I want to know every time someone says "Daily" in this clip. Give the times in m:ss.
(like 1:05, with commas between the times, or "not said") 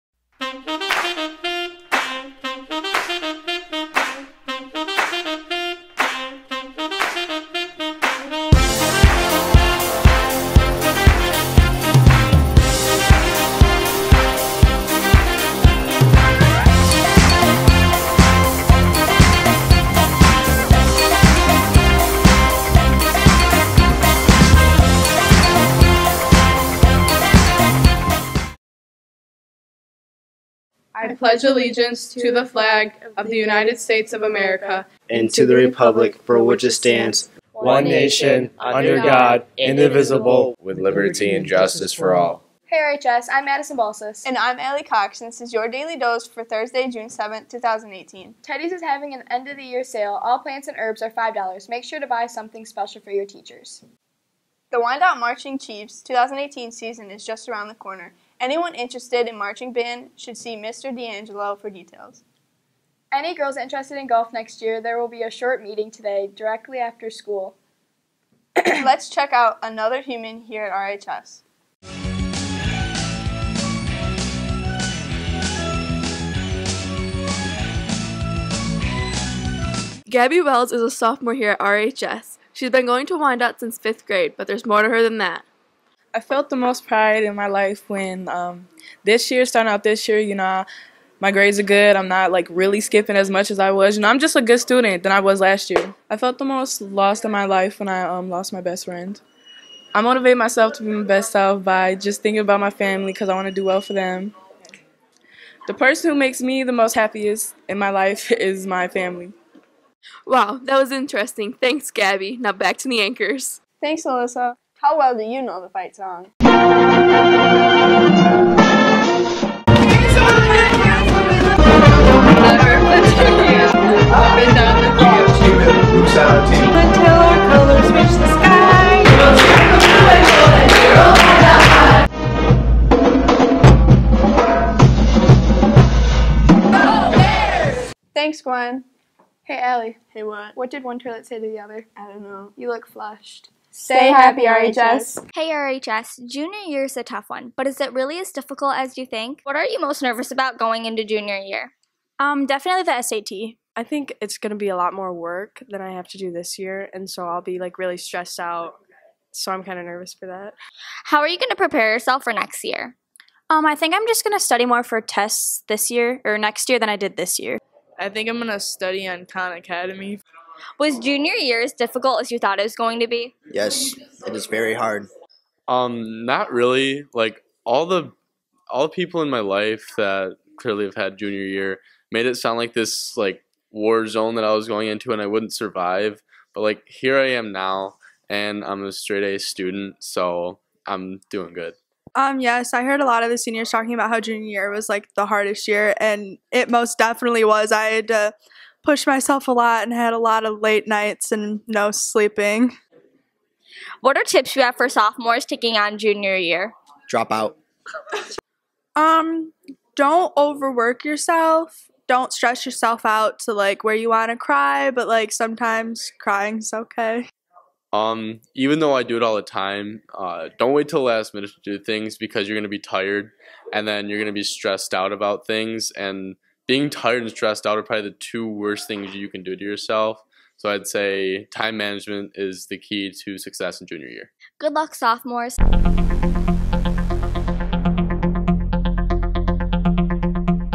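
0:45.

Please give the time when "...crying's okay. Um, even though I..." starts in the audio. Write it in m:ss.
3:36.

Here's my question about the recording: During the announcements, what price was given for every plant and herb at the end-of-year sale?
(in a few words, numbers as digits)
$5.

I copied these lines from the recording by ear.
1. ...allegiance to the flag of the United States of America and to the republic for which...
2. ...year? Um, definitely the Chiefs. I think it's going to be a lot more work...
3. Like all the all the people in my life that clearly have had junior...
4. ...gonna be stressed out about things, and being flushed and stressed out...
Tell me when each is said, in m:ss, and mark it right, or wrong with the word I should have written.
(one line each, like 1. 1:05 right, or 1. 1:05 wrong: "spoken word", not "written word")
1. 0:31 right
2. 2:31 wrong: "SAT", not "Chiefs"
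3. 2:57 right
4. 3:44 wrong: "tired", not "flushed".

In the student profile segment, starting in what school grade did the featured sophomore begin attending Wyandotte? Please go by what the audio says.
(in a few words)
Fifth grade.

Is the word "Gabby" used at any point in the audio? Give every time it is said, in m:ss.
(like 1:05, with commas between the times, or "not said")
1:20, 1:51.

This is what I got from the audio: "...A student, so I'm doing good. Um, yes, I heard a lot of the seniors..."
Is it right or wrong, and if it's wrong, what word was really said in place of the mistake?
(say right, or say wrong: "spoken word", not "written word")
right.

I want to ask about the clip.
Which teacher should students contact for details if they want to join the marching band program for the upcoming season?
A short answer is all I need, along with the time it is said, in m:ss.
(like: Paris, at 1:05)
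Mr. D'Angelo, at 1:00.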